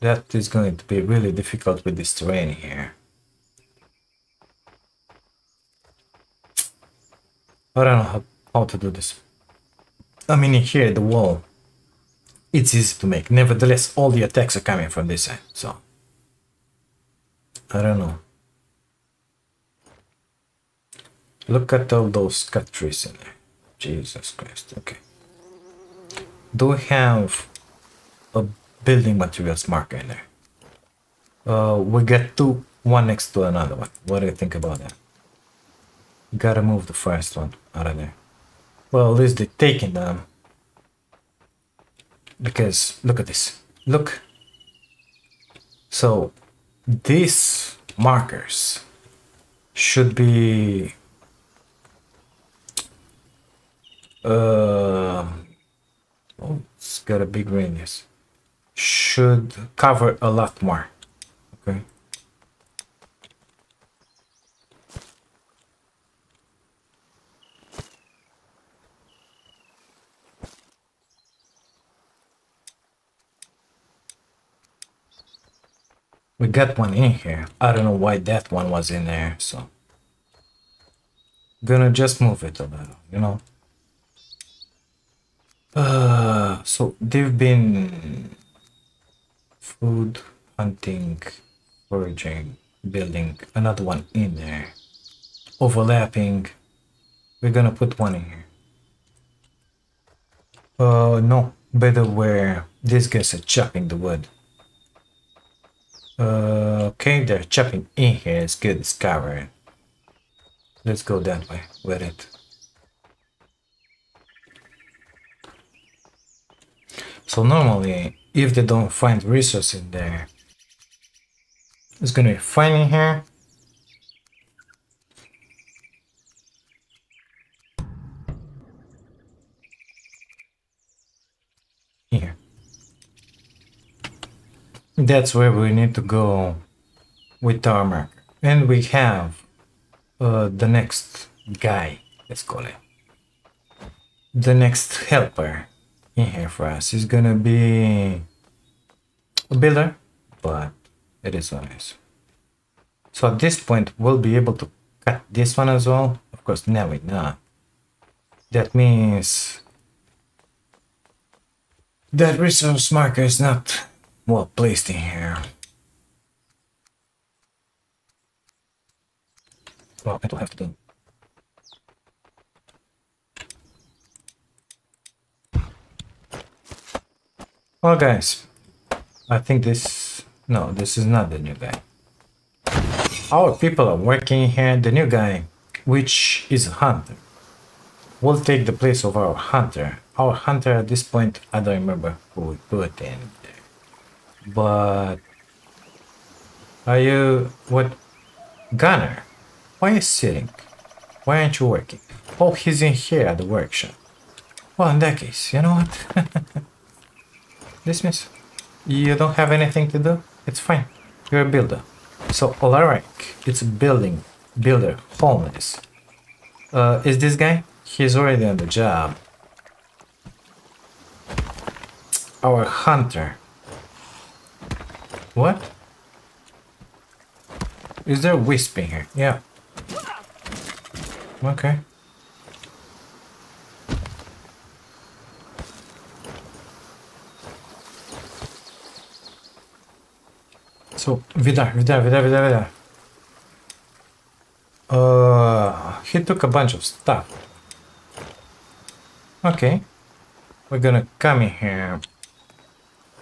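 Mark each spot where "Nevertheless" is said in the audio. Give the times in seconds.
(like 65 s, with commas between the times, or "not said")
13 s.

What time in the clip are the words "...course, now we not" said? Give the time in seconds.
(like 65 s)
156 s.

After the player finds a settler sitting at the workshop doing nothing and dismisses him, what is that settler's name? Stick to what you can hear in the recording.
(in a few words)
Gunner.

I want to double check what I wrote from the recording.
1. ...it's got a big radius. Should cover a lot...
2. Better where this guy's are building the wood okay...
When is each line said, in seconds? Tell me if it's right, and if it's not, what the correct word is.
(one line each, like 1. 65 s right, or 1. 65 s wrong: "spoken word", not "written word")
1. 56 s right
2. 101 s wrong: "chopping", not "building".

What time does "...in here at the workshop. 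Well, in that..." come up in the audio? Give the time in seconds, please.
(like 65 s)
202 s.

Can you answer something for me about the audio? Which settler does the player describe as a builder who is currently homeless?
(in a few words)
Alaric.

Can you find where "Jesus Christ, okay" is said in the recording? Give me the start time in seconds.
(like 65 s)
23 s.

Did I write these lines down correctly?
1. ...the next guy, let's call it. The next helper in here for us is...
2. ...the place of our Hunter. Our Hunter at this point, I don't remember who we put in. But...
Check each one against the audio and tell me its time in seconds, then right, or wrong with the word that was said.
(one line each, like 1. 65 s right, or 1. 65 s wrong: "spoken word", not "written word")
1. 140 s right
2. 188 s right.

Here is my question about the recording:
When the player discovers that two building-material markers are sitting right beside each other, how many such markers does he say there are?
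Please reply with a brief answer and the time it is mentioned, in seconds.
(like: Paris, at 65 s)
2, at 32 s.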